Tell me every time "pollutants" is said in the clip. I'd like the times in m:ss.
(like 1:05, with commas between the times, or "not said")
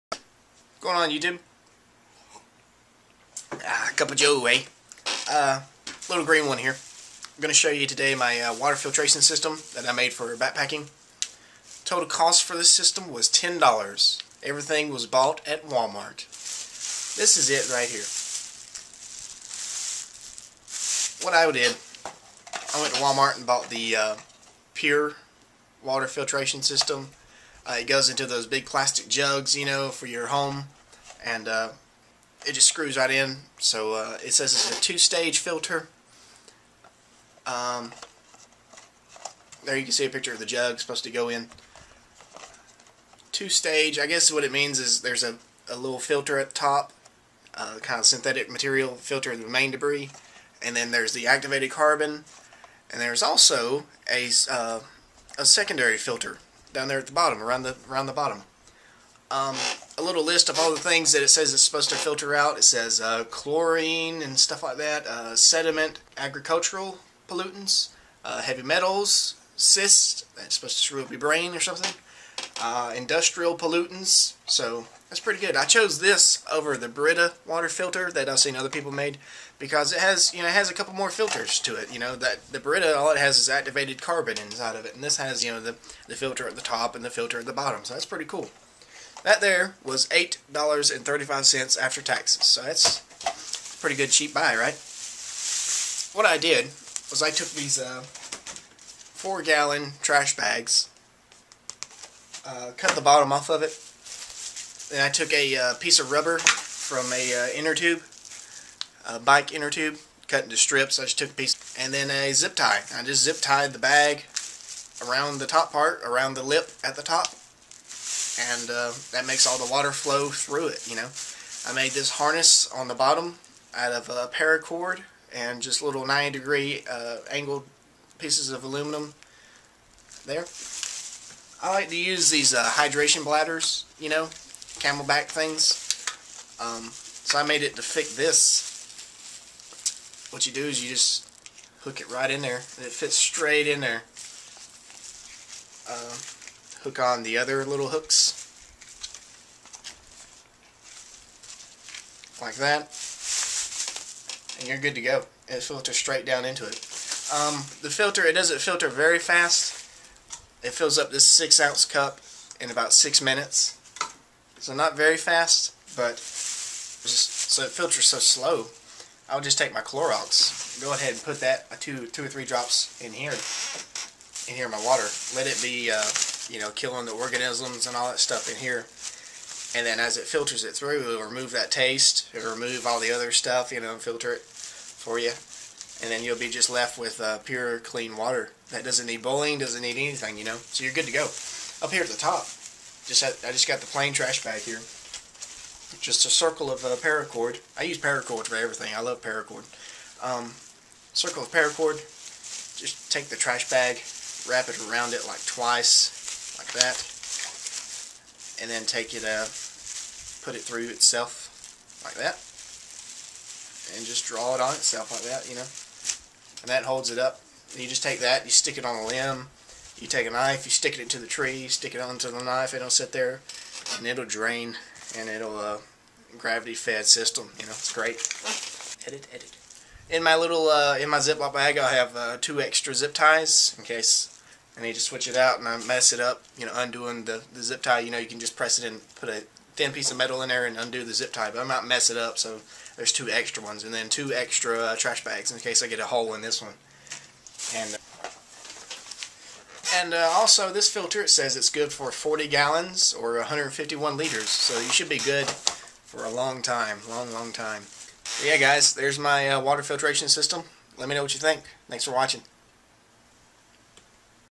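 1:07, 1:13.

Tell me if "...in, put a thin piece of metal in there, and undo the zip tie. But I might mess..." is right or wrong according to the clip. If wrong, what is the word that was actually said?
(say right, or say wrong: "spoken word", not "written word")
right.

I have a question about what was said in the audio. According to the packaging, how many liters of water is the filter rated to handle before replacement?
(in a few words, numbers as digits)
151.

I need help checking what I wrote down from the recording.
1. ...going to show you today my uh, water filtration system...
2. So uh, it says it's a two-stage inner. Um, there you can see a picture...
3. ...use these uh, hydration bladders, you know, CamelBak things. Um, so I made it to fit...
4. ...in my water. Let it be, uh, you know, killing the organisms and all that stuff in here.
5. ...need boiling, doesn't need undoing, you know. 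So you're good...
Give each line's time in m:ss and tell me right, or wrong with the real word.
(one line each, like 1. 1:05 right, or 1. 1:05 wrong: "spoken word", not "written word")
1. 0:07 right
2. 0:33 wrong: "filter", not "inner"
3. 2:11 right
4. 2:54 right
5. 3:09 wrong: "anything", not "undoing".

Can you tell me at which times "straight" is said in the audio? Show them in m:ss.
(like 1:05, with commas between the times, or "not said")
2:23, 2:35.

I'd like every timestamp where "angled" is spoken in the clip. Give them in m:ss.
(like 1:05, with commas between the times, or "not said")
2:07.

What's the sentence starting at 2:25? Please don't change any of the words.
Uh, hook on the other little hooks.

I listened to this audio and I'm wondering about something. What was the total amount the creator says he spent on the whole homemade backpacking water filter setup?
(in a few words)
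$10.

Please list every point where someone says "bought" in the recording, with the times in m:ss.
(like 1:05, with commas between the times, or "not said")
0:15, 0:23.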